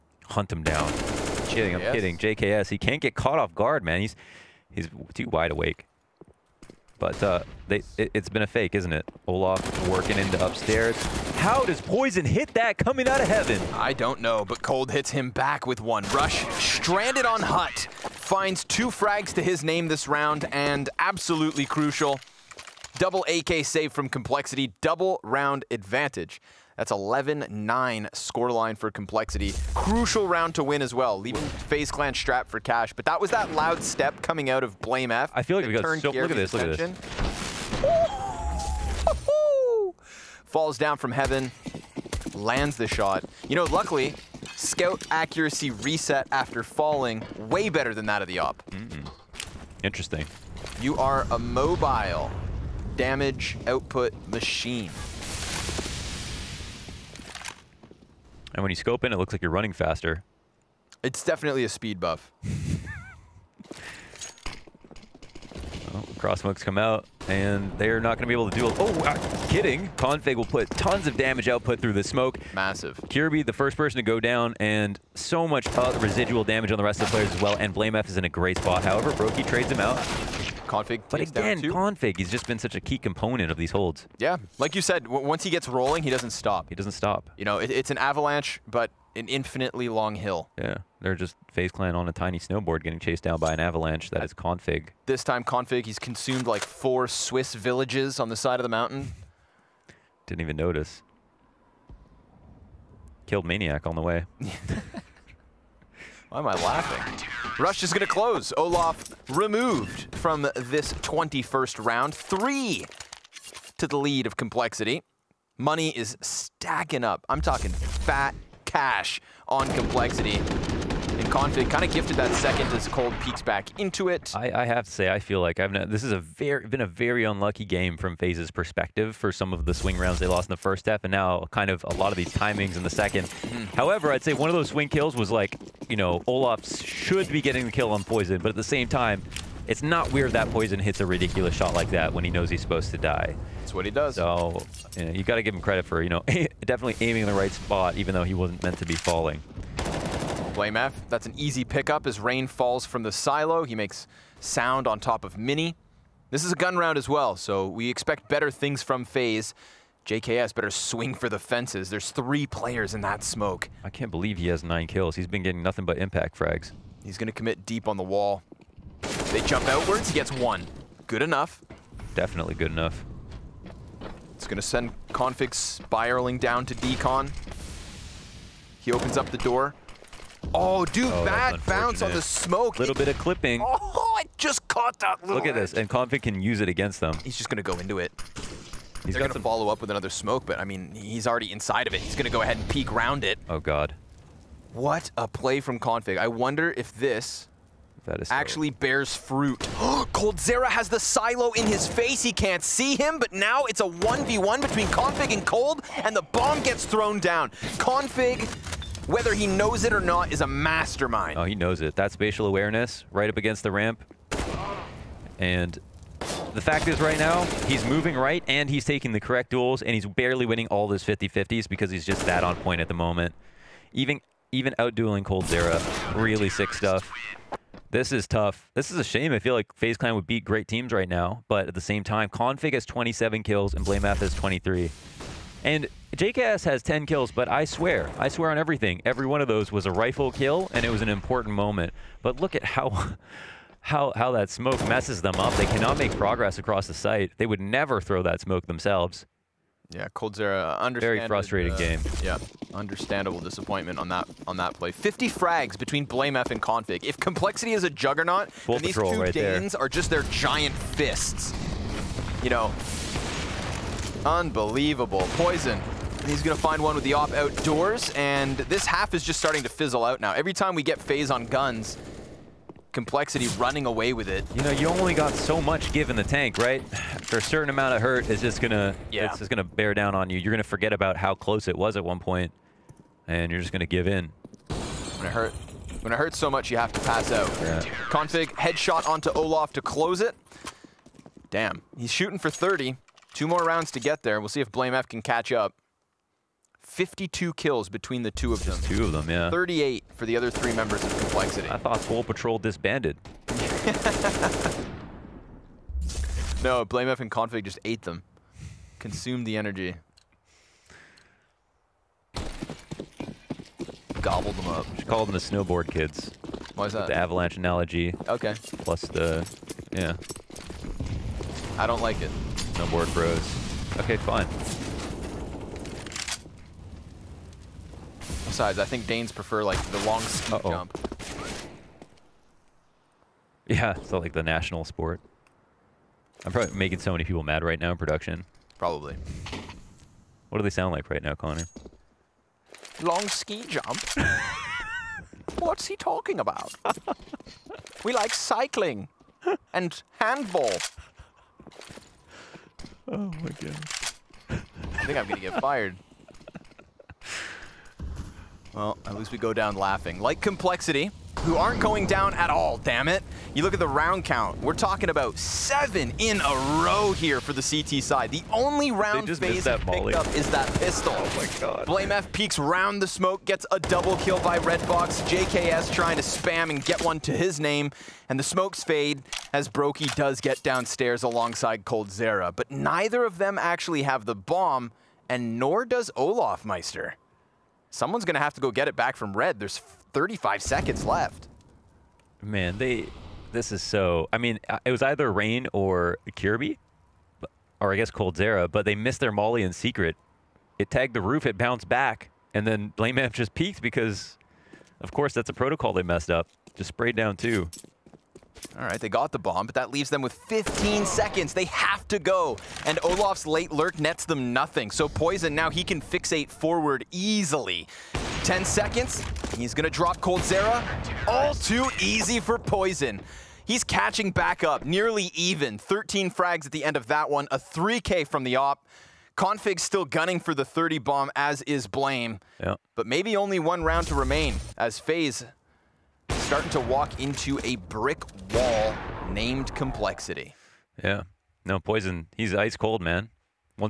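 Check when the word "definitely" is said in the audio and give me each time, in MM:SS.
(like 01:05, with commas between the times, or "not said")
01:01, 02:26, 02:52.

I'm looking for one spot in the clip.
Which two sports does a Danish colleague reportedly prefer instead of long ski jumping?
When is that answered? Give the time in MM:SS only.
05:48.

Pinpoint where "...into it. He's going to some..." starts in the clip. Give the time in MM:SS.
03:07.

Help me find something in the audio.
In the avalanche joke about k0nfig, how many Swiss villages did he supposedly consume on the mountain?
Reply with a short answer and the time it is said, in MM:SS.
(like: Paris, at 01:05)
4, at 01:36.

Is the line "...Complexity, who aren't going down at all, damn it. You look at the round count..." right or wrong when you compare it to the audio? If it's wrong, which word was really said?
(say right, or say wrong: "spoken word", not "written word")
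right.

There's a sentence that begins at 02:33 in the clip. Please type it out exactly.
He makes sound on top of Mini.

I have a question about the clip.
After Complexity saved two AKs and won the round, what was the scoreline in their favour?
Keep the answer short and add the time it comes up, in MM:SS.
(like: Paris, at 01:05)
11-9, at 00:26.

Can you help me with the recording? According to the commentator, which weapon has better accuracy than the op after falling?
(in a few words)
Scout.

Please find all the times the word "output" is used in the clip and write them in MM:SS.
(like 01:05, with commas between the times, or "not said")
00:53, 01:11.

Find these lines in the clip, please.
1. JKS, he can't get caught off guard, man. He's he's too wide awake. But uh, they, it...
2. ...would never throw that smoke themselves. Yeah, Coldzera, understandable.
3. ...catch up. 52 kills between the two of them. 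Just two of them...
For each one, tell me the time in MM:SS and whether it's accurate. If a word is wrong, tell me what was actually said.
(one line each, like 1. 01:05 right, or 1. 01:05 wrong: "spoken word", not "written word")
1. 00:02 right
2. 04:07 right
3. 04:55 right.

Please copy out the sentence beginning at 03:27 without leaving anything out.
k0nfig whether he knows it or not, is a mastermind.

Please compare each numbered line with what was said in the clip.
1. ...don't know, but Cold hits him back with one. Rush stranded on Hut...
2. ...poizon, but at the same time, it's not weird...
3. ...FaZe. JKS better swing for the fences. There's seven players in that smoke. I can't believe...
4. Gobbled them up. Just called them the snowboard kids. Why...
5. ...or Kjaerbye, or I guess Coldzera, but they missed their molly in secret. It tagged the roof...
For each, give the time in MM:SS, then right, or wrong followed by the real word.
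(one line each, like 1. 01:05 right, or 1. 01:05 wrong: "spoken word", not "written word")
1. 00:13 right
2. 02:18 right
3. 02:39 wrong: "three", not "seven"
4. 05:14 right
5. 06:35 right.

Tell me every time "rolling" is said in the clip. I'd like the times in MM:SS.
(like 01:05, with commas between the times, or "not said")
01:25.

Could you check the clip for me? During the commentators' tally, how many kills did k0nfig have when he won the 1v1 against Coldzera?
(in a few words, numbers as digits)
27.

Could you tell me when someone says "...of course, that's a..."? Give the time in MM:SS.
06:45.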